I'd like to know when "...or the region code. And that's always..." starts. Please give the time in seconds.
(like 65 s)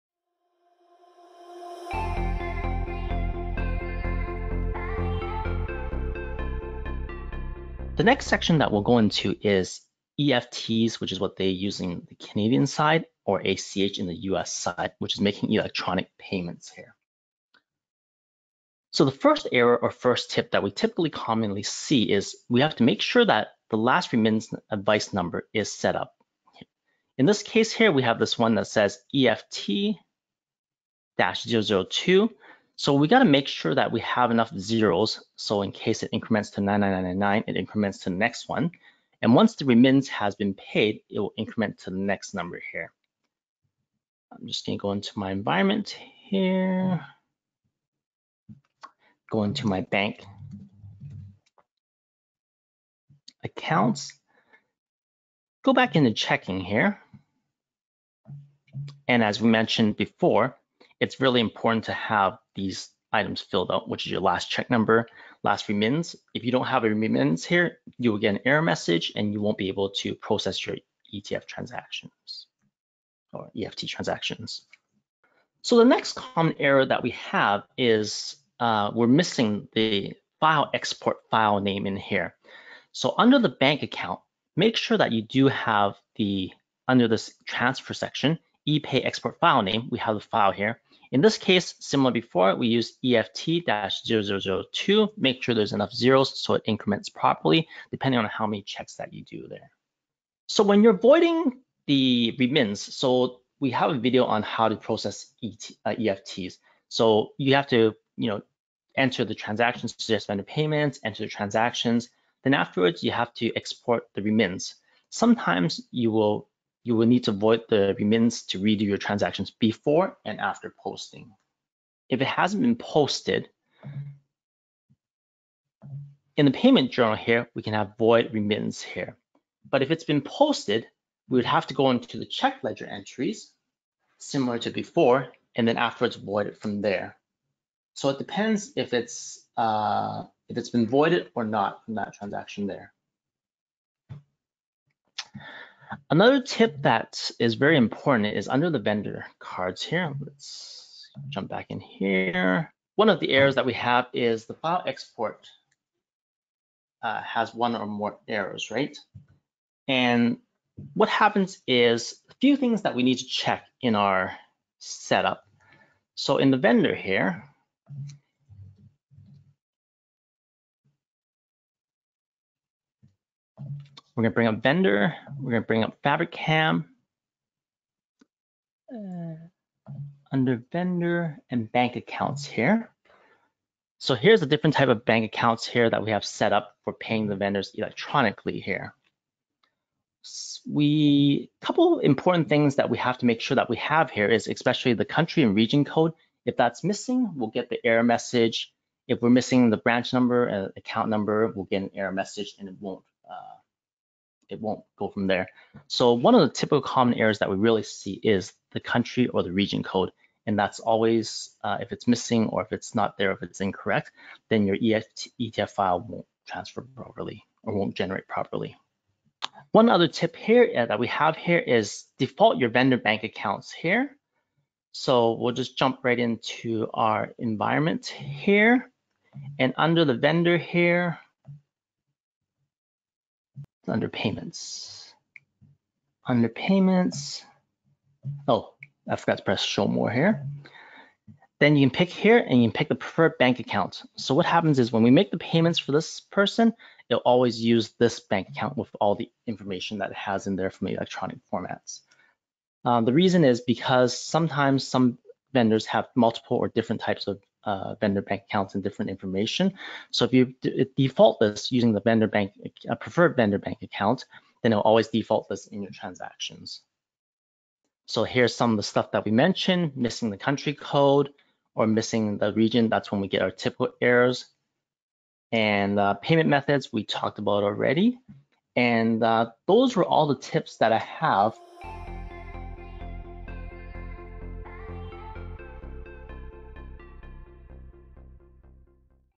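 209 s.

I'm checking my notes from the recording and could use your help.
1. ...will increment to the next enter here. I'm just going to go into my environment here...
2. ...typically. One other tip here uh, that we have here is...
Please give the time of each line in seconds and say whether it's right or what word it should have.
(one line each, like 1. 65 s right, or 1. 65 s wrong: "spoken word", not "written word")
1. 41 s wrong: "number", not "enter"
2. 218 s wrong: "properly", not "typically".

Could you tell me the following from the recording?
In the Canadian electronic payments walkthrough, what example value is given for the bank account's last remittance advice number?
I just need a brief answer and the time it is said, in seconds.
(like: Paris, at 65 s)
EFT-002, at 29 s.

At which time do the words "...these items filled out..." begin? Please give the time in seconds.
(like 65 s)
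62 s.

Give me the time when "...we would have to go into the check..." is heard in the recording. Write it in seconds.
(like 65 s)
131 s.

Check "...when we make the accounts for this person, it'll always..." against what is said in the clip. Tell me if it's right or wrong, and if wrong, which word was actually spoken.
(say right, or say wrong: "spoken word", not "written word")
wrong: "payments", not "accounts".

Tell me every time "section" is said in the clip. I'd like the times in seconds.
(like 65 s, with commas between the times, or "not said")
8 s, 87 s.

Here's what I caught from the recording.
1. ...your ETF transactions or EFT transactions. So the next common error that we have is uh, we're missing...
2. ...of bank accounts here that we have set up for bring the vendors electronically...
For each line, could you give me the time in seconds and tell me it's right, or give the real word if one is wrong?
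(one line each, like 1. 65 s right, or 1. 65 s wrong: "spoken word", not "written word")
1. 70 s right
2. 184 s wrong: "paying", not "bring".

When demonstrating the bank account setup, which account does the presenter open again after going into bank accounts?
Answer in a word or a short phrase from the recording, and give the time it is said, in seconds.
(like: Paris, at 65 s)
checking, at 56 s.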